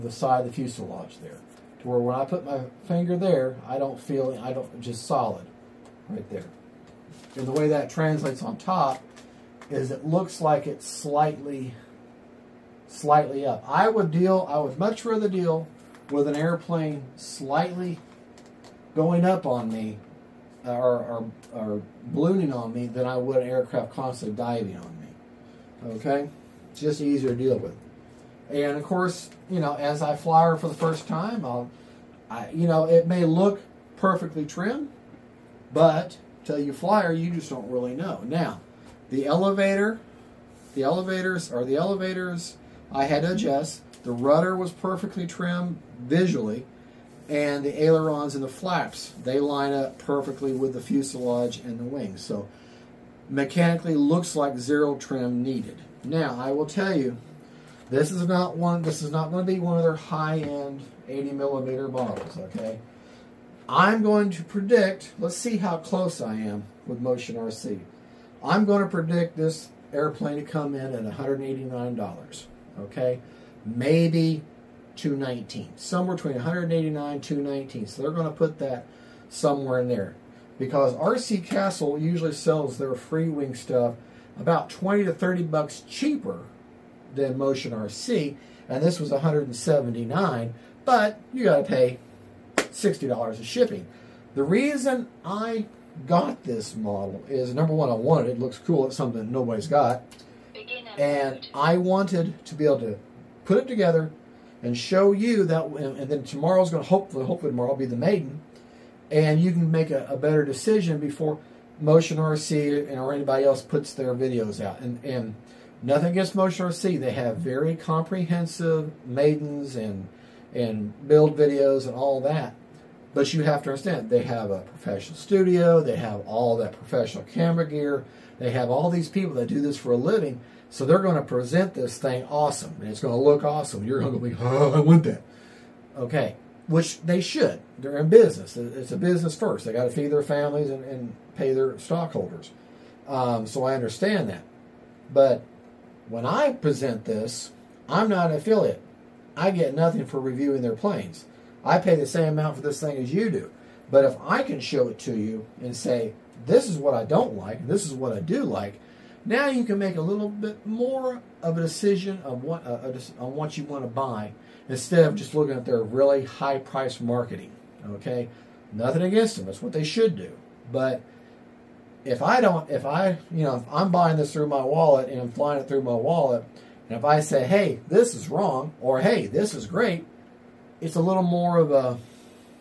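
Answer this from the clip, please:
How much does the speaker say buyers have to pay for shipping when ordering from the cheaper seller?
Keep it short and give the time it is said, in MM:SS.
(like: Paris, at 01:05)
$60, at 01:32.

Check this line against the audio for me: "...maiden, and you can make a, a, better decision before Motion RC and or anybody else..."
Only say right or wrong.
right.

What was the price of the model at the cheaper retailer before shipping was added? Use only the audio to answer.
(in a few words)
179.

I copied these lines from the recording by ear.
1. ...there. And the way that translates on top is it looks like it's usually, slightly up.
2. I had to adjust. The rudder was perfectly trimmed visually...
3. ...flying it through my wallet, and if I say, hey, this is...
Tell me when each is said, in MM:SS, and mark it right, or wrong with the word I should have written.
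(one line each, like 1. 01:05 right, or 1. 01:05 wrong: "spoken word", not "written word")
1. 00:06 wrong: "slightly", not "usually"
2. 00:42 right
3. 02:55 right.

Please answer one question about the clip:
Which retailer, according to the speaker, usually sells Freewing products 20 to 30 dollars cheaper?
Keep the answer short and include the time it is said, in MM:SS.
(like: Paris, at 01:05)
RC Castle, at 01:20.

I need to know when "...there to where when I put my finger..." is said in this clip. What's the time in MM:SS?
00:01.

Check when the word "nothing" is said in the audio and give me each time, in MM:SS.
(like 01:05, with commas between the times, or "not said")
01:55, 02:29, 02:48.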